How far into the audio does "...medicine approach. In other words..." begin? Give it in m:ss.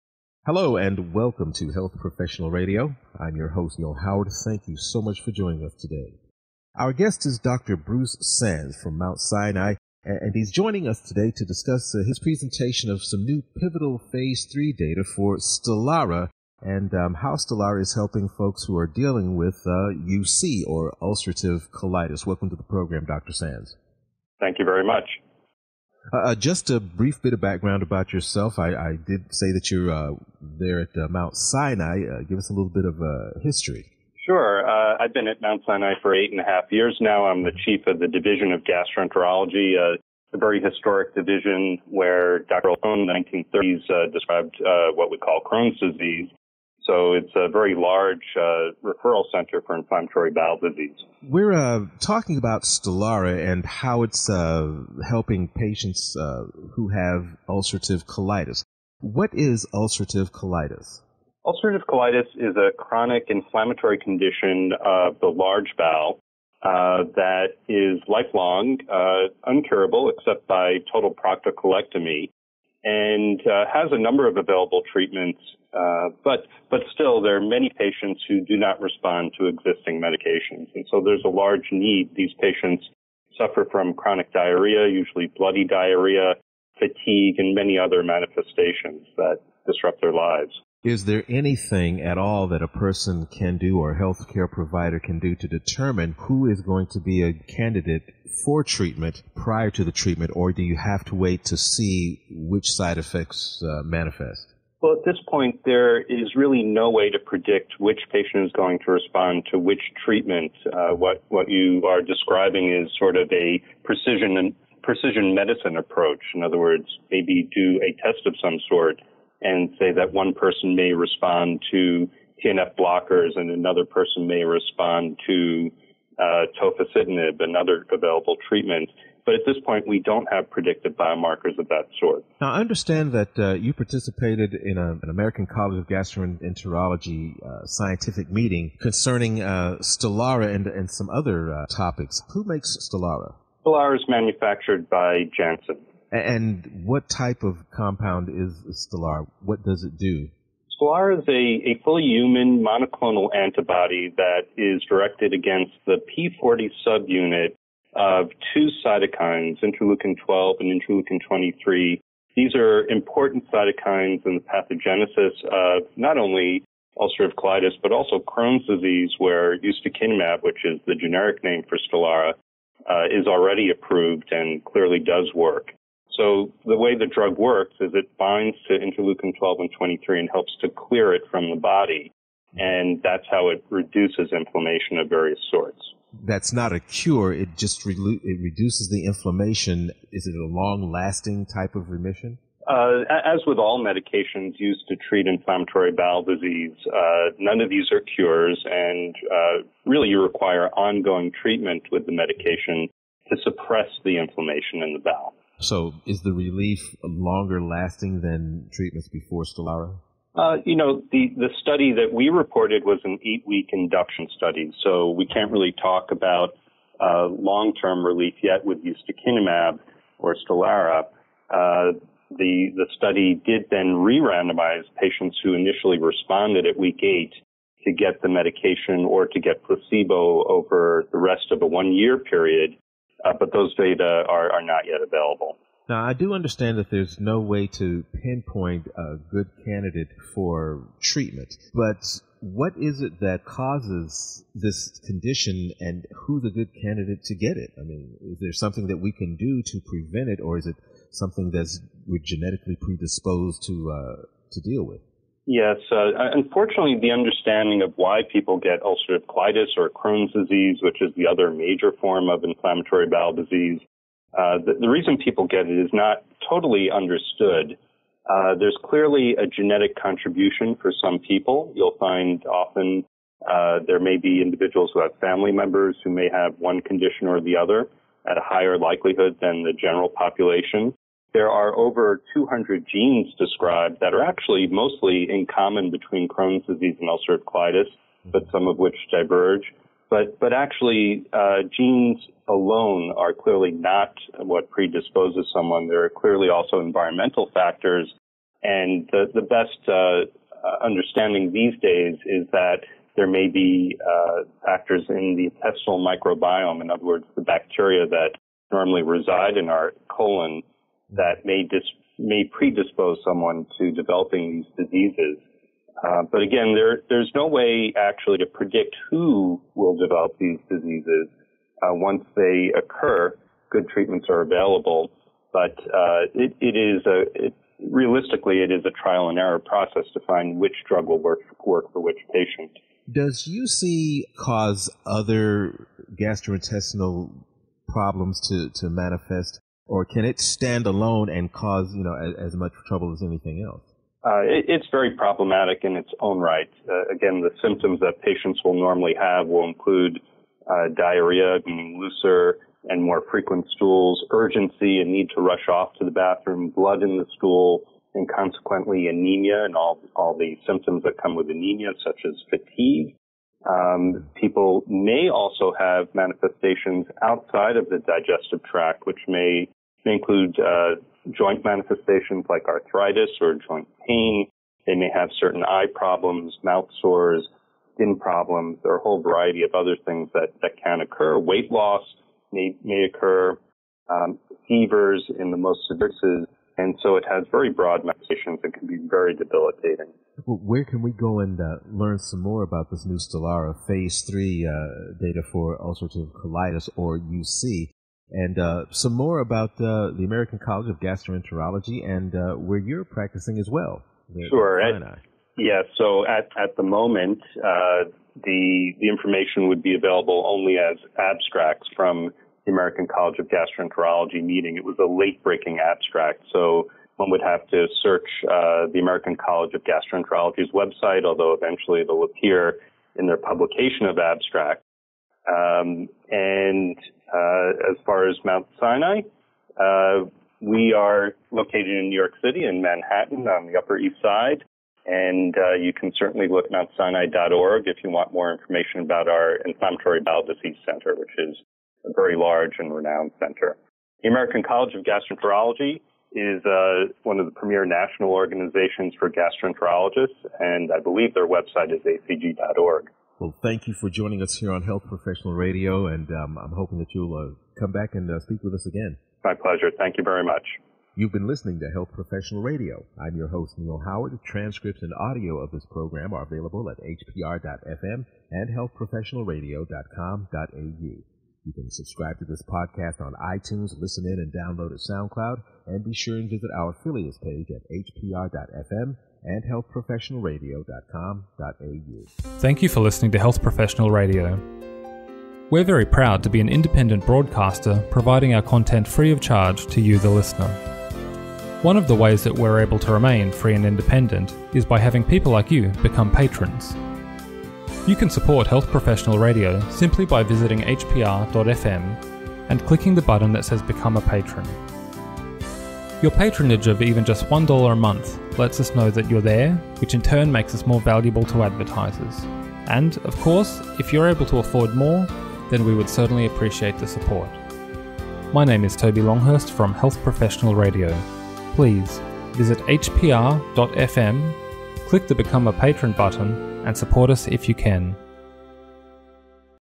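1:55.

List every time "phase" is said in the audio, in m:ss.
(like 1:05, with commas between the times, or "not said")
0:14, 6:33.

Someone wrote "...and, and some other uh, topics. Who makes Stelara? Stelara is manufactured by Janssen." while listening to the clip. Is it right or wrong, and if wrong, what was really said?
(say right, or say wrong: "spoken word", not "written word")
right.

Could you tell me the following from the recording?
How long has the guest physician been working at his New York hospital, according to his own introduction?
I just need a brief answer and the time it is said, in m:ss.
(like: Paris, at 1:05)
8.5 years, at 0:36.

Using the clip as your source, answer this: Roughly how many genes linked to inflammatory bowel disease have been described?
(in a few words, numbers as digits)
over 200.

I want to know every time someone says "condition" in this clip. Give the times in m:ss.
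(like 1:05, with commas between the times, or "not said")
1:03, 4:05, 4:36.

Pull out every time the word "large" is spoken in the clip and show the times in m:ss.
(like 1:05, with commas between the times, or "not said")
0:47, 1:05, 1:21, 7:22.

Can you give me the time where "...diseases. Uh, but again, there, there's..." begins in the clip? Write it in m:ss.
5:14.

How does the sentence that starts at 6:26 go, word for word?
And so it has very broad manifestations and can be very debilitating.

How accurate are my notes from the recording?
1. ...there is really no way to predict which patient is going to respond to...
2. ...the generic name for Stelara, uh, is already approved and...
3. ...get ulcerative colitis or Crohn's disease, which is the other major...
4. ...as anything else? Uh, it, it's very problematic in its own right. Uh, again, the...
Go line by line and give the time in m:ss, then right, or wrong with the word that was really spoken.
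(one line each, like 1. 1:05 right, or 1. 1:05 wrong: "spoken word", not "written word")
1. 1:45 right
2. 2:50 right
3. 4:18 right
4. 5:43 right.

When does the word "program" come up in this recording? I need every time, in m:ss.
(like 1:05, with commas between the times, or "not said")
0:22, 7:45.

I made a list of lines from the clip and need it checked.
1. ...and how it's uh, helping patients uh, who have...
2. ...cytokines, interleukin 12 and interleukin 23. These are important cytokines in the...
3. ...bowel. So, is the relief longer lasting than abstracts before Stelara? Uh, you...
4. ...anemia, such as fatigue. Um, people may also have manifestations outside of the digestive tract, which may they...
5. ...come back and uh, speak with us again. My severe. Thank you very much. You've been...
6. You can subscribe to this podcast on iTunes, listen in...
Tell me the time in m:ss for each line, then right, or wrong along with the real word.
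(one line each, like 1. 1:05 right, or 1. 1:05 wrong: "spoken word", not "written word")
1. 0:53 right
2. 2:38 right
3. 3:25 wrong: "treatments", not "abstracts"
4. 6:01 right
5. 7:37 wrong: "pleasure", not "severe"
6. 7:51 right.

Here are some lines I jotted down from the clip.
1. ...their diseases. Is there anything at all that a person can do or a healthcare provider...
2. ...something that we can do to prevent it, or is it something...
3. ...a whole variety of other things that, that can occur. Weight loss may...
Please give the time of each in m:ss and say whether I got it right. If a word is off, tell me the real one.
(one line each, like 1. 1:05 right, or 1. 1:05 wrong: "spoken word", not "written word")
1. 1:30 wrong: "lives", not "diseases"
2. 4:08 right
3. 6:18 right.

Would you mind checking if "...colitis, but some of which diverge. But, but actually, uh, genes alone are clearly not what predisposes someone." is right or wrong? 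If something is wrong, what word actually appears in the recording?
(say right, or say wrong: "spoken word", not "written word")
right.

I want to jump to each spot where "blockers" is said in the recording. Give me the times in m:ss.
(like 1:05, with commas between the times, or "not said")
2:02.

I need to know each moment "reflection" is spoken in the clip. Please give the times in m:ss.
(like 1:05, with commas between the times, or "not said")
not said.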